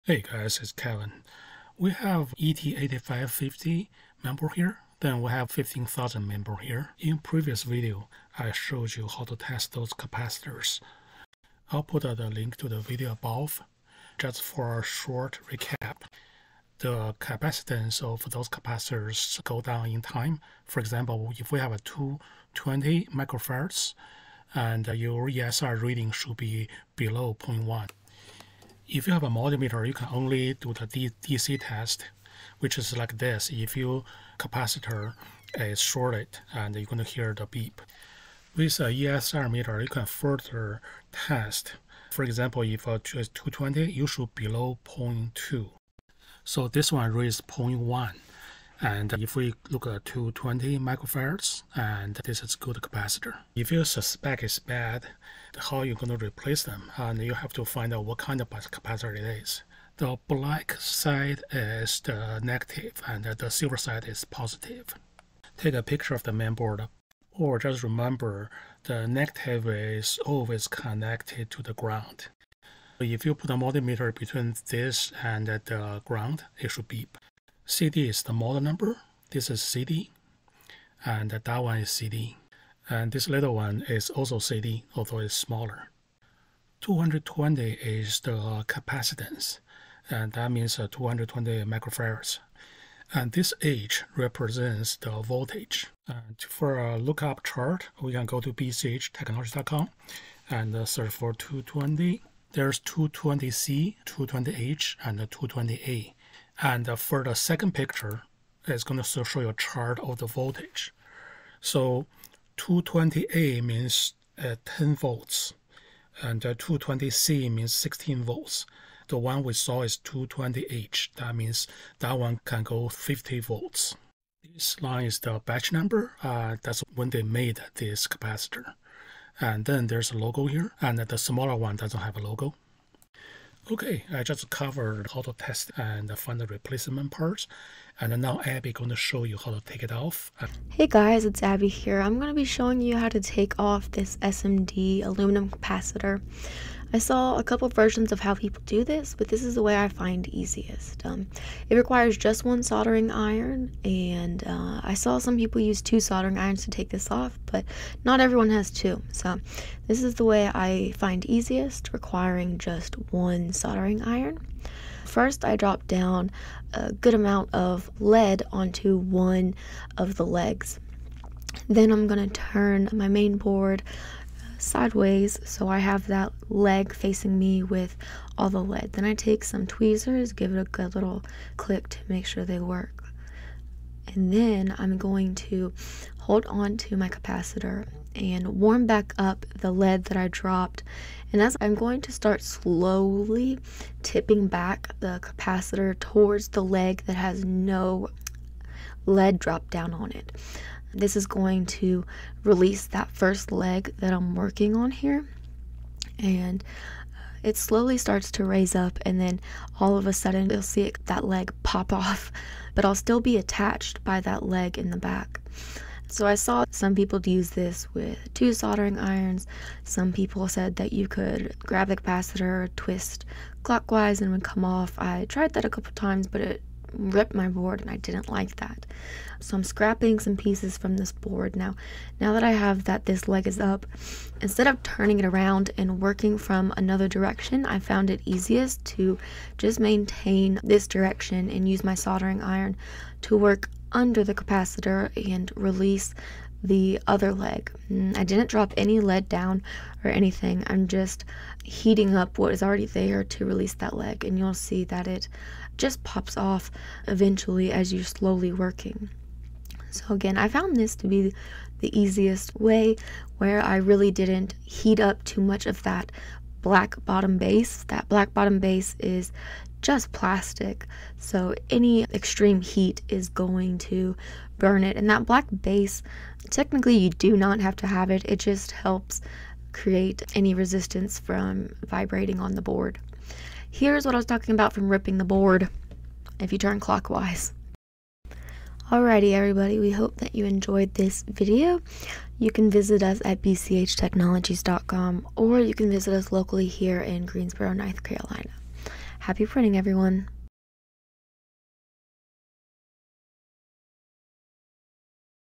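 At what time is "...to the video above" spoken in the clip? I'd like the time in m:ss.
0:12.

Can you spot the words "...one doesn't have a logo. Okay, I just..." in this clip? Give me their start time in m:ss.
2:11.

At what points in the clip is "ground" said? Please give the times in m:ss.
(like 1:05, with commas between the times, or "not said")
1:11, 1:16.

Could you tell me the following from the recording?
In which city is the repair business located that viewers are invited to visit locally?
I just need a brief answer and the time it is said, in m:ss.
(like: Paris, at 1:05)
Greensboro, at 4:57.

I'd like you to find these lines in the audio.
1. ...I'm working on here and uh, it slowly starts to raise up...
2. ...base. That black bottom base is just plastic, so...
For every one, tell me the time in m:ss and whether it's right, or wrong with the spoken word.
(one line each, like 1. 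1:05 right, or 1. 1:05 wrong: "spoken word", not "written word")
1. 3:24 right
2. 4:27 right.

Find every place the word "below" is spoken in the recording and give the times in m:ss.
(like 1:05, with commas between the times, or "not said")
0:26, 0:44.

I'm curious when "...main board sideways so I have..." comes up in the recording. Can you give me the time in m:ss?
2:53.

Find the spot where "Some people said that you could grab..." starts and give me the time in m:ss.
3:39.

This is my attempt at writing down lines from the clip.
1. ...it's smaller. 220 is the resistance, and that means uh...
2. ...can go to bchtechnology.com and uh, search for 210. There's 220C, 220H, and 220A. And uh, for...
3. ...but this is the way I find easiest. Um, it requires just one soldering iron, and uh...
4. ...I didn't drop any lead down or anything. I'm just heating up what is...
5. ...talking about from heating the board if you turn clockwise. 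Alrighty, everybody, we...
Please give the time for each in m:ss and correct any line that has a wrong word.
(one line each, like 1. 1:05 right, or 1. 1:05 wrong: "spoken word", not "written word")
1. 1:25 wrong: "capacitance", not "resistance"
2. 1:38 wrong: "220", not "210"
3. 2:29 right
4. 4:08 right
5. 4:44 wrong: "ripping", not "heating".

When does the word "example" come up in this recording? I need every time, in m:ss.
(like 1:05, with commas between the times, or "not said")
0:20, 0:42.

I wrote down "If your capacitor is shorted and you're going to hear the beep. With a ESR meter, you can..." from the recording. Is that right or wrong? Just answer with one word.
right.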